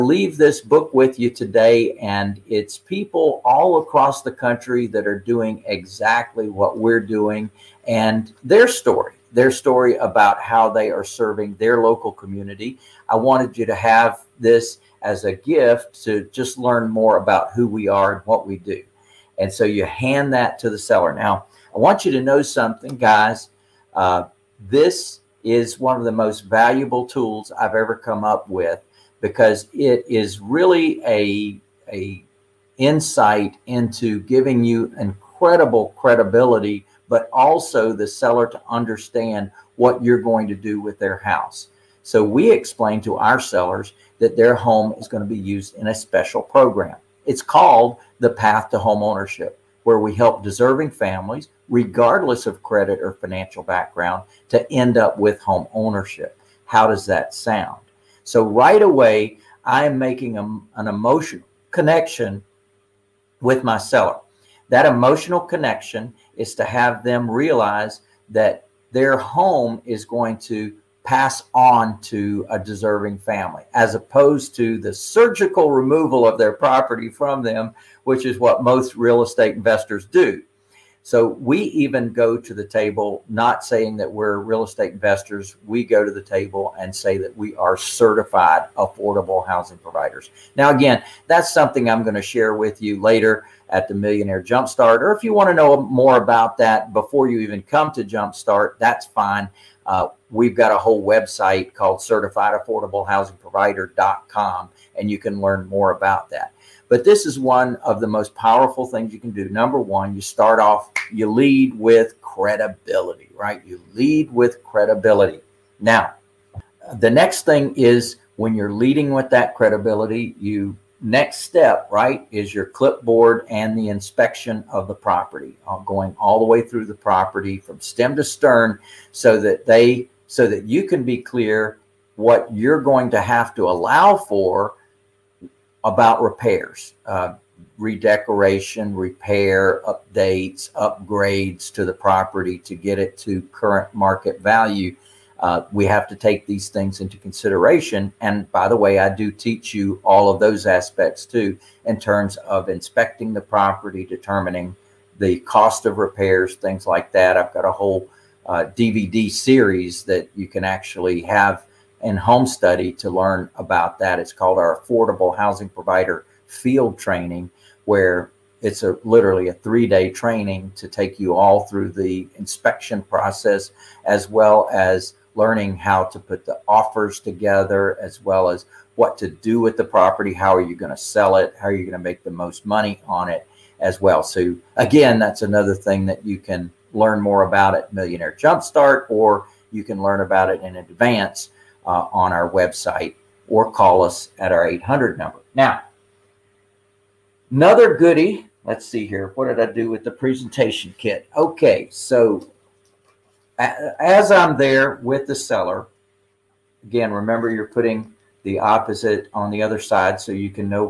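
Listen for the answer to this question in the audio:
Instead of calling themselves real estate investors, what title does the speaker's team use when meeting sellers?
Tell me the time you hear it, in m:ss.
1:27.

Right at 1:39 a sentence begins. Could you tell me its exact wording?
Uh, we've got a whole website called certifiedaffordablehousingprovider.com, and you can learn more about that.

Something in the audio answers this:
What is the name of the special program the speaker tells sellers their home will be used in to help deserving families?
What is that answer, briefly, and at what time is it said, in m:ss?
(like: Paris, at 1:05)
Path to Home Ownership, at 0:48.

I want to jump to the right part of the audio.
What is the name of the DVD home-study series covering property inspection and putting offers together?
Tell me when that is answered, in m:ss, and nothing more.
2:44.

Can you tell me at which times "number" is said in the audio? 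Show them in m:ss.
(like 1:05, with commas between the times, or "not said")
1:49, 3:15.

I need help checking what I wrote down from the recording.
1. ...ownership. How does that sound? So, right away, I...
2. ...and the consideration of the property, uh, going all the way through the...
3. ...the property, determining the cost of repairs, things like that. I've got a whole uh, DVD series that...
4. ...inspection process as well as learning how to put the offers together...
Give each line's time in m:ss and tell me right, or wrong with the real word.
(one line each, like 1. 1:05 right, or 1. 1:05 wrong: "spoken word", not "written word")
1. 0:55 right
2. 2:03 wrong: "inspection", not "consideration"
3. 2:33 right
4. 2:52 right.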